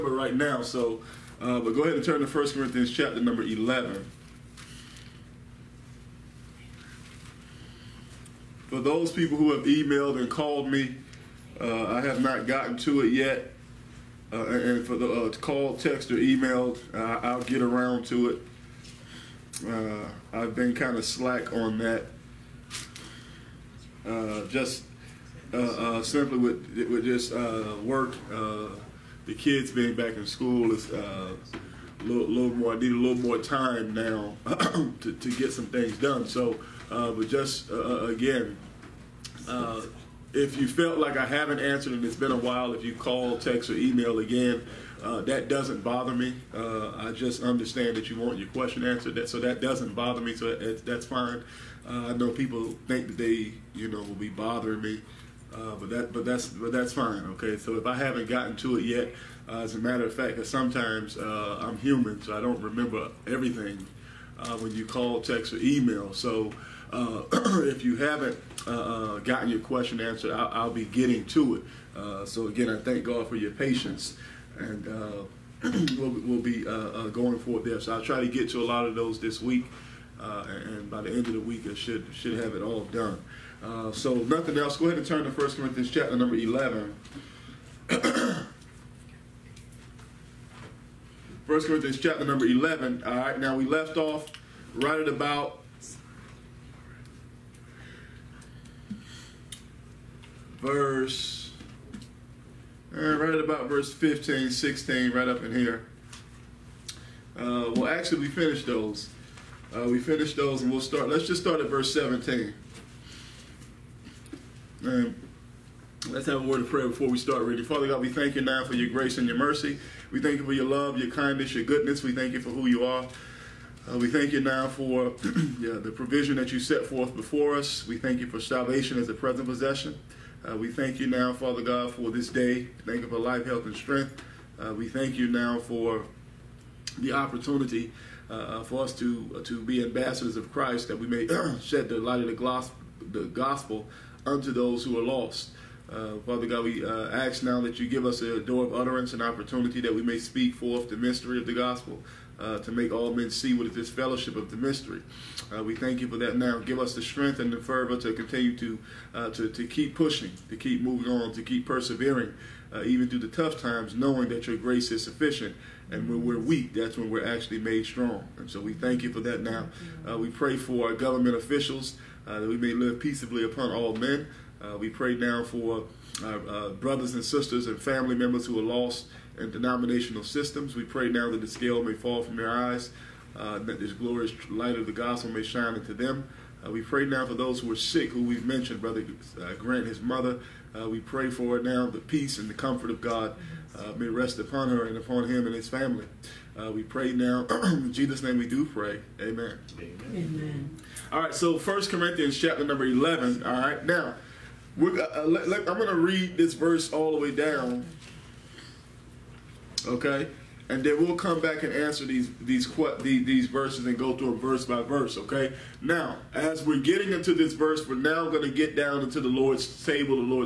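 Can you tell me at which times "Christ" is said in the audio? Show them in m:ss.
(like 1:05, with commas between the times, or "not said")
2:20.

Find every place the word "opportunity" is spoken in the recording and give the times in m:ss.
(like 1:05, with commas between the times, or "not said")
2:17, 2:29.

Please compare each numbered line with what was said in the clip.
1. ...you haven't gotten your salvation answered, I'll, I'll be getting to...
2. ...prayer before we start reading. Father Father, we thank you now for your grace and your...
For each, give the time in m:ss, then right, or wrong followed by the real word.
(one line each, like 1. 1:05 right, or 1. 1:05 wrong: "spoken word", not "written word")
1. 1:07 wrong: "question", not "salvation"
2. 1:56 wrong: "God", not "Father".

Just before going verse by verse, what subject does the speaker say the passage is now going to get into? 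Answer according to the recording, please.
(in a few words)
the Lord's table.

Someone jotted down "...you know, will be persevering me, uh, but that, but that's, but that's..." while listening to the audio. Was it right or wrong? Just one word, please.
wrong.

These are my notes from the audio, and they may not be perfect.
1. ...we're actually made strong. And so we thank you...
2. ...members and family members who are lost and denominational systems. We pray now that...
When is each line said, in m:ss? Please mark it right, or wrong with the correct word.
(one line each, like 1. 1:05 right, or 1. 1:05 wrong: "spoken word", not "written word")
1. 2:47 right
2. 2:57 wrong: "sisters", not "members".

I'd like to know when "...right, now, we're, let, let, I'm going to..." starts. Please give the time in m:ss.
3:23.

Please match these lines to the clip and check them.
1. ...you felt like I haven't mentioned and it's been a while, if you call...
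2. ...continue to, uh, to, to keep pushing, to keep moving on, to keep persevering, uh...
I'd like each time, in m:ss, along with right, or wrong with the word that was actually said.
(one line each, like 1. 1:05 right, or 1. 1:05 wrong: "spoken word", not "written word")
1. 0:40 wrong: "answered", not "mentioned"
2. 2:38 right.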